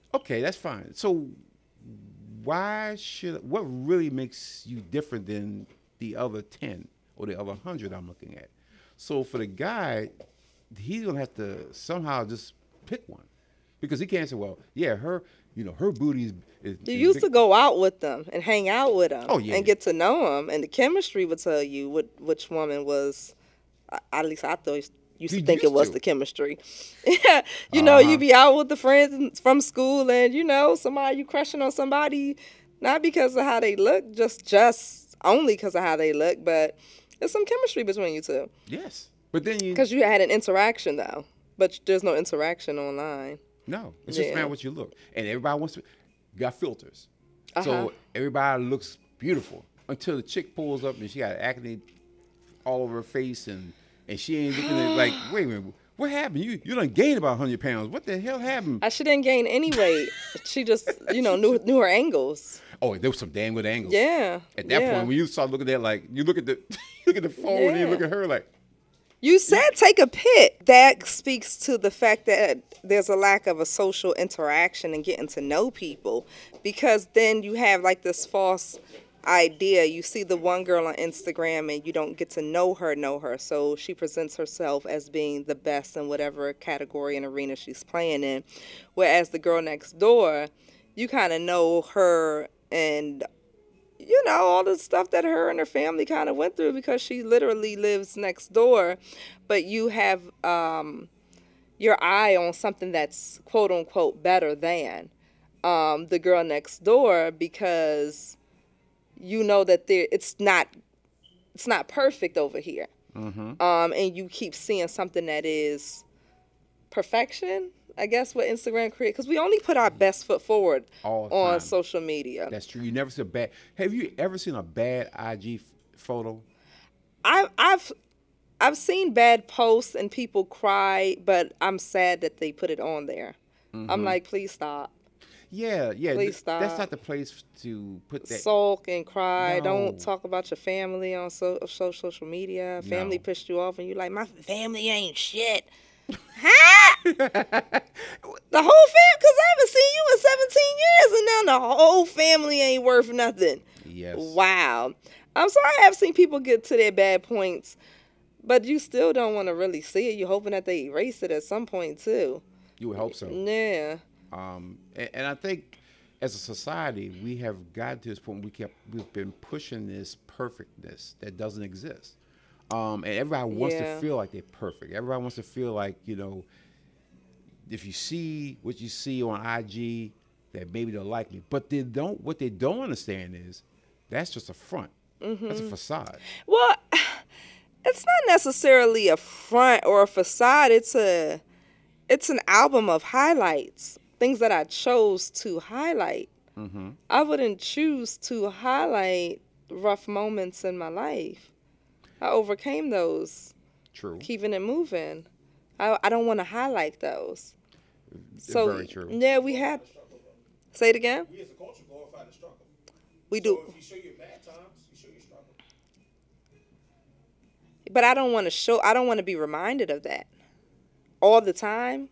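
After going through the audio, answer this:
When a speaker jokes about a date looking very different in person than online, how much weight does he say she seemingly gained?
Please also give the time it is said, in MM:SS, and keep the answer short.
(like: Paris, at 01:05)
100 pounds, at 00:57.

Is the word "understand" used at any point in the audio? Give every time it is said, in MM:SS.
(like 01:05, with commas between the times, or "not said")
03:02.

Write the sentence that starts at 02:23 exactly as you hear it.
pissed you off, and you're like, my family ain't shit.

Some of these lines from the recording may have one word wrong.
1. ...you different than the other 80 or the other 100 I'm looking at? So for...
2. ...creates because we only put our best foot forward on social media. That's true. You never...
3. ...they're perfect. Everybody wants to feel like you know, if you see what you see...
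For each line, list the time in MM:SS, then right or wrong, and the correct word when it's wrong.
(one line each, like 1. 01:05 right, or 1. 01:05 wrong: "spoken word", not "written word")
1. 00:04 wrong: "10", not "80"
2. 01:58 right
3. 02:54 right.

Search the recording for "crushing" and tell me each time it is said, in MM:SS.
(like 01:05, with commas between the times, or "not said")
00:31.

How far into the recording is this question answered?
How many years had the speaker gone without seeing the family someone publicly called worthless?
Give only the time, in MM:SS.
02:30.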